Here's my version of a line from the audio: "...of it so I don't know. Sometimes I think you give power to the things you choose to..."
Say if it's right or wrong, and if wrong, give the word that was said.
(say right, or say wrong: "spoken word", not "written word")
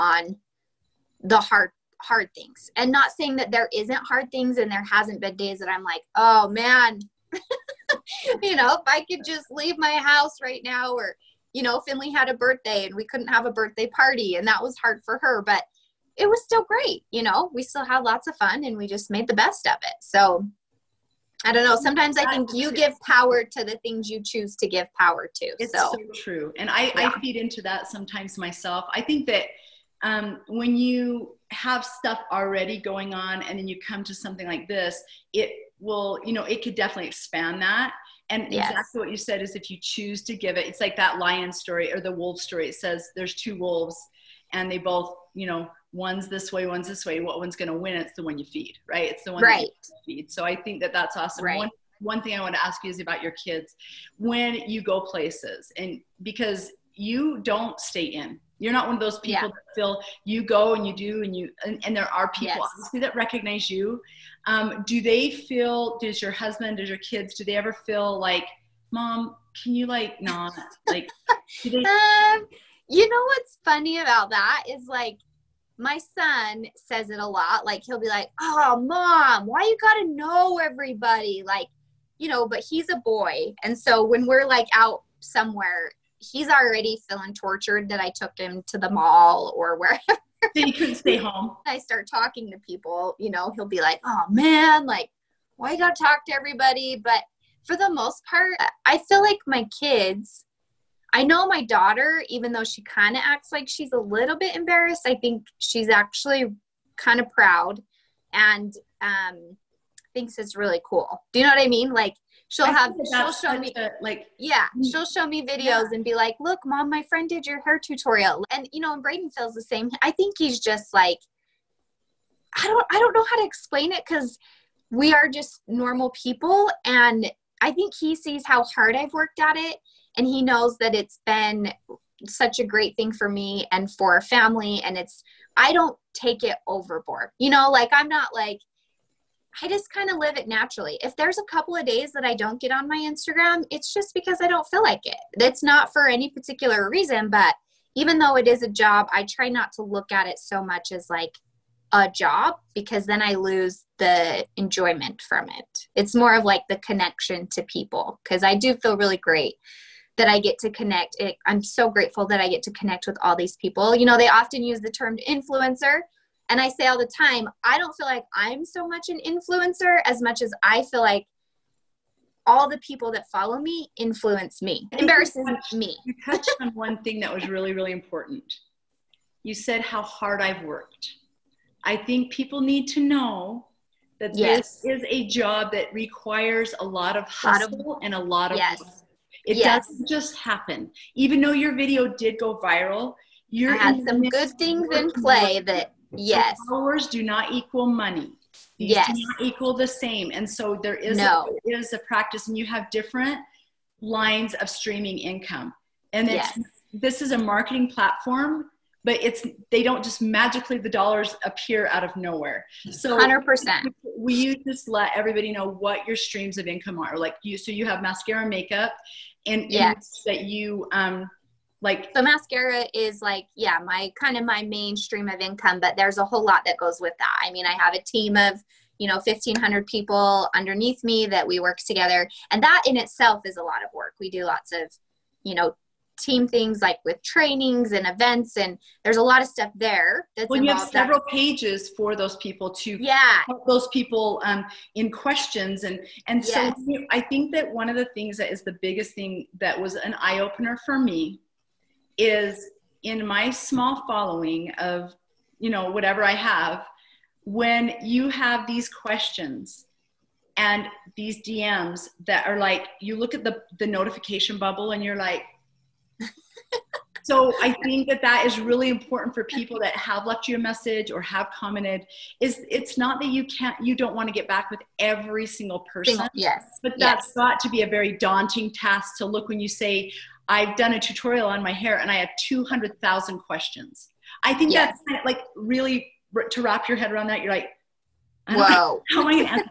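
right.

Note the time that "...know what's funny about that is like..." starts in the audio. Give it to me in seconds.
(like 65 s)
73 s.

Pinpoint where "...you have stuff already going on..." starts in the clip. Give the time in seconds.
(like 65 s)
30 s.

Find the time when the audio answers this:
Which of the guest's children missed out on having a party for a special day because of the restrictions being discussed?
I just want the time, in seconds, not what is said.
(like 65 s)
11 s.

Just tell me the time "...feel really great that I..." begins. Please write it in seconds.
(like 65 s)
158 s.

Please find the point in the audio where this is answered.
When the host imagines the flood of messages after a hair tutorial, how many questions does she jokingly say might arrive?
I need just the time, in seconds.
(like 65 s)
282 s.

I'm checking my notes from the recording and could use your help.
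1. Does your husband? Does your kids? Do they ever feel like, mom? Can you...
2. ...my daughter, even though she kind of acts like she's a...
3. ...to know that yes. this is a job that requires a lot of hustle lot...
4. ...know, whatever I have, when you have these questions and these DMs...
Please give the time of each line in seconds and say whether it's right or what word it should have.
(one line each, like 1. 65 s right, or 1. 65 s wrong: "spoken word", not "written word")
1. 65 s right
2. 101 s right
3. 182 s right
4. 255 s right.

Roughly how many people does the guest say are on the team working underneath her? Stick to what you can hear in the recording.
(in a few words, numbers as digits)
1500.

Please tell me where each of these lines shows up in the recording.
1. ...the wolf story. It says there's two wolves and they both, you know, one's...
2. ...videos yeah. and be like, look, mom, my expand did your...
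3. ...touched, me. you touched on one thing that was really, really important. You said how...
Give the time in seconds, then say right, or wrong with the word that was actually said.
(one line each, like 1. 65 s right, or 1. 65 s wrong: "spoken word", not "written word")
1. 41 s right
2. 115 s wrong: "friend", not "expand"
3. 175 s right.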